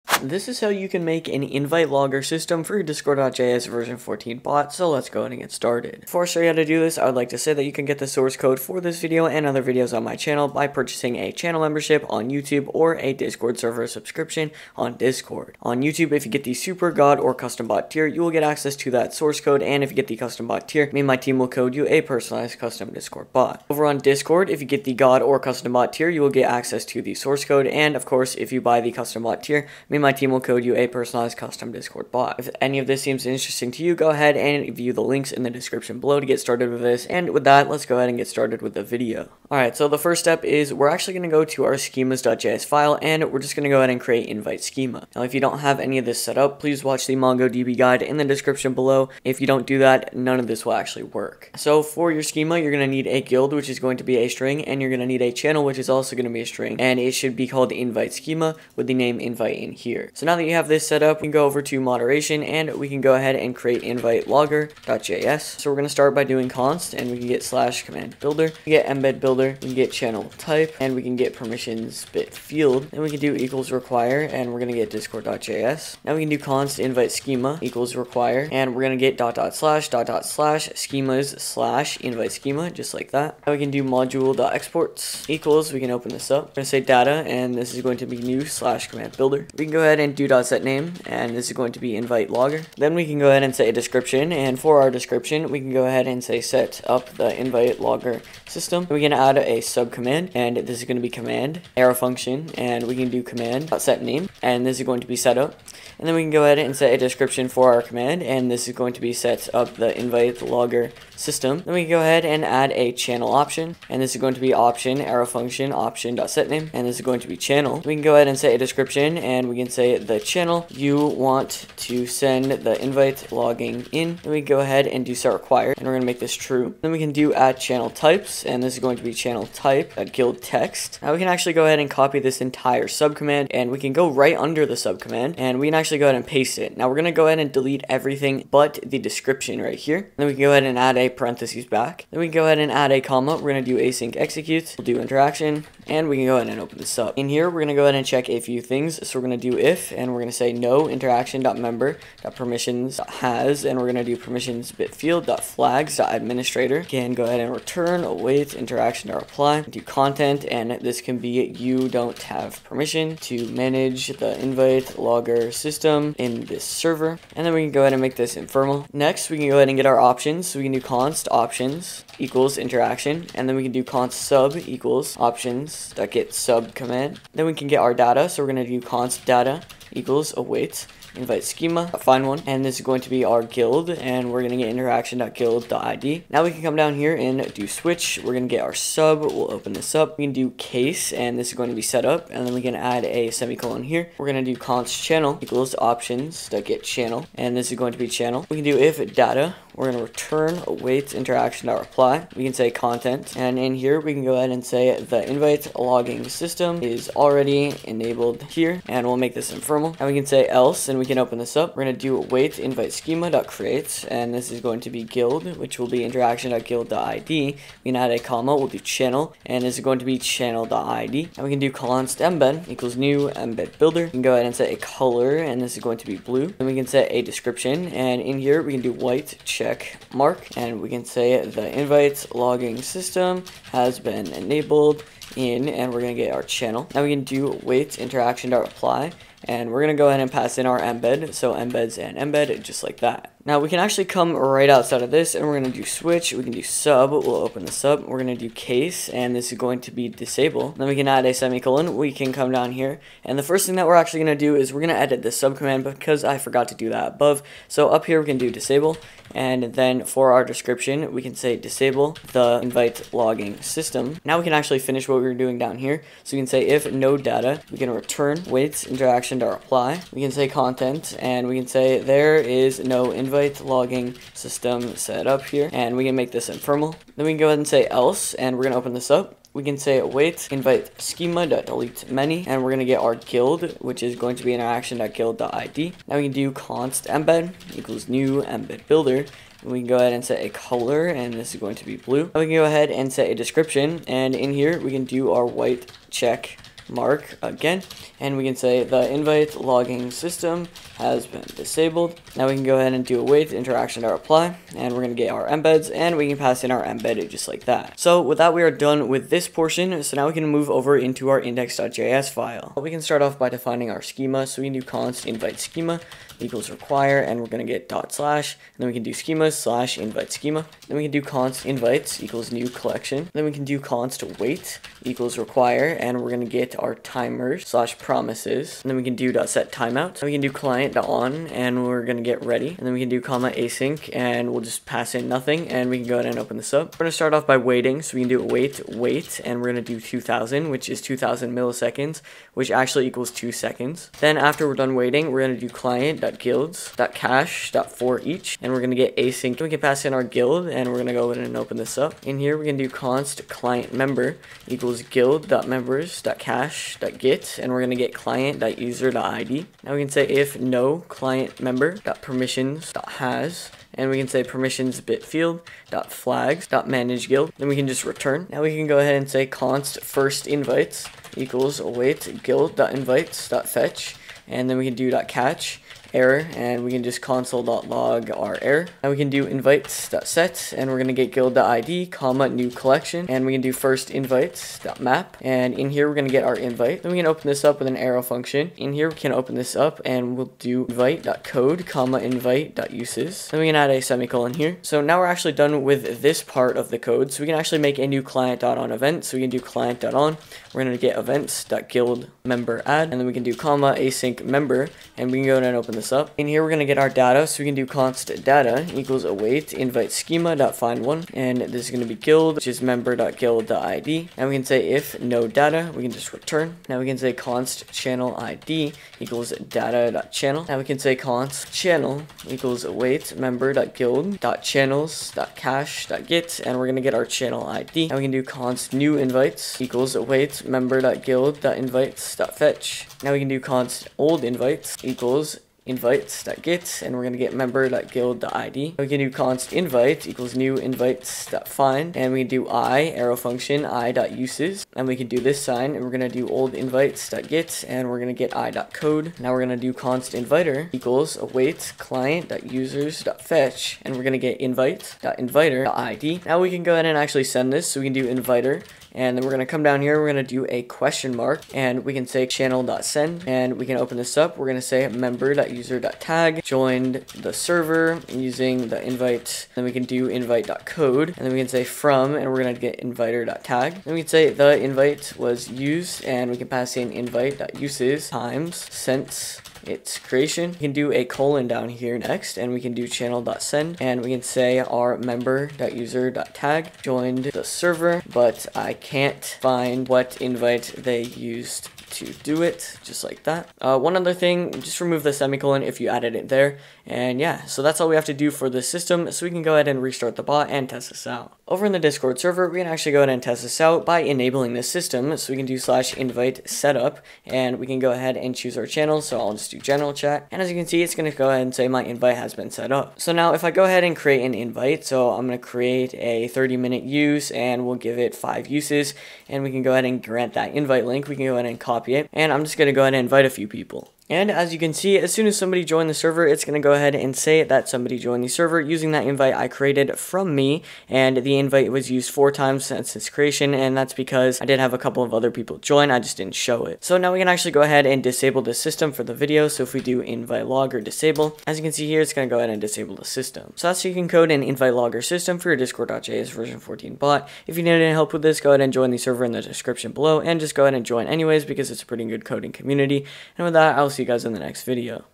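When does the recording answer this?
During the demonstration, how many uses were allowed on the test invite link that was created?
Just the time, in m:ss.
8:38.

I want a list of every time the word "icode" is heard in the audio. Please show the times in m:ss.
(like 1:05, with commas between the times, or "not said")
7:28.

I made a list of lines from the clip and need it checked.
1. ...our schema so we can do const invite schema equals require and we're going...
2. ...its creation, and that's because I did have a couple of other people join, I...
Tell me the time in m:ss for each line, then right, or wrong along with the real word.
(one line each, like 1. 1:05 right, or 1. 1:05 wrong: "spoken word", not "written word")
1. 5:13 right
2. 8:53 right.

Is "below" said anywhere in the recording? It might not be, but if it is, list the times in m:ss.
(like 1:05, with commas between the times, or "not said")
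0:36, 0:48, 9:10.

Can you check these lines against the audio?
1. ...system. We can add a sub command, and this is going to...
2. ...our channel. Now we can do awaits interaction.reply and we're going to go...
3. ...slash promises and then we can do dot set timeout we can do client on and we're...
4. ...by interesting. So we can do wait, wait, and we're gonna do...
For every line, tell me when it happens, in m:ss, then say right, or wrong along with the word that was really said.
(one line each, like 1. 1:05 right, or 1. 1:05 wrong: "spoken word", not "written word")
1. 1:38 right
2. 3:56 wrong: "weights", not "awaits"
3. 5:27 right
4. 5:37 wrong: "waiting", not "interesting".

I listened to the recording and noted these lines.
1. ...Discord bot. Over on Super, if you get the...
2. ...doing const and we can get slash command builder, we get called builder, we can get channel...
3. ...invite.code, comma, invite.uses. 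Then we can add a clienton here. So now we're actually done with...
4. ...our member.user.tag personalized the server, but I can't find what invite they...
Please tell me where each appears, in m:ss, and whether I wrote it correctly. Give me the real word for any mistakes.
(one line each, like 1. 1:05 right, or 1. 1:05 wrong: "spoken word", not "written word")
1. 0:22 wrong: "Discord", not "Super"
2. 1:06 wrong: "embed", not "called"
3. 6:30 wrong: "semicolon", not "clienton"
4. 8:04 wrong: "joined", not "personalized".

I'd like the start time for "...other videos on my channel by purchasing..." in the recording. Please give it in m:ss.
0:09.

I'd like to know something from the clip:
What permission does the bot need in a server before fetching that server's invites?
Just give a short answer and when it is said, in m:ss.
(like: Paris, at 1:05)
manage guild, at 6:06.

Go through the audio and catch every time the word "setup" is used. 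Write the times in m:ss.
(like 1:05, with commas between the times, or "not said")
1:45, 8:26.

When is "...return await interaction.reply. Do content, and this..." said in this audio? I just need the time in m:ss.
2:37.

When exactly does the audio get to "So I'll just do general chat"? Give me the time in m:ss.
8:29.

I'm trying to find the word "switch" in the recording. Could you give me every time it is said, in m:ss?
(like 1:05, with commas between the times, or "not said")
3:07, 4:05.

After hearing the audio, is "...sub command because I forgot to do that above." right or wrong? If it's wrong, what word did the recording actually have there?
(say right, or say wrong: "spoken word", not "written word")
right.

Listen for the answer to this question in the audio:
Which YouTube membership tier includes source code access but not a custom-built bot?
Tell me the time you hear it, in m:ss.
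0:16.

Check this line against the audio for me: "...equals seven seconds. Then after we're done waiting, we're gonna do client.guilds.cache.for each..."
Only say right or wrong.
wrong.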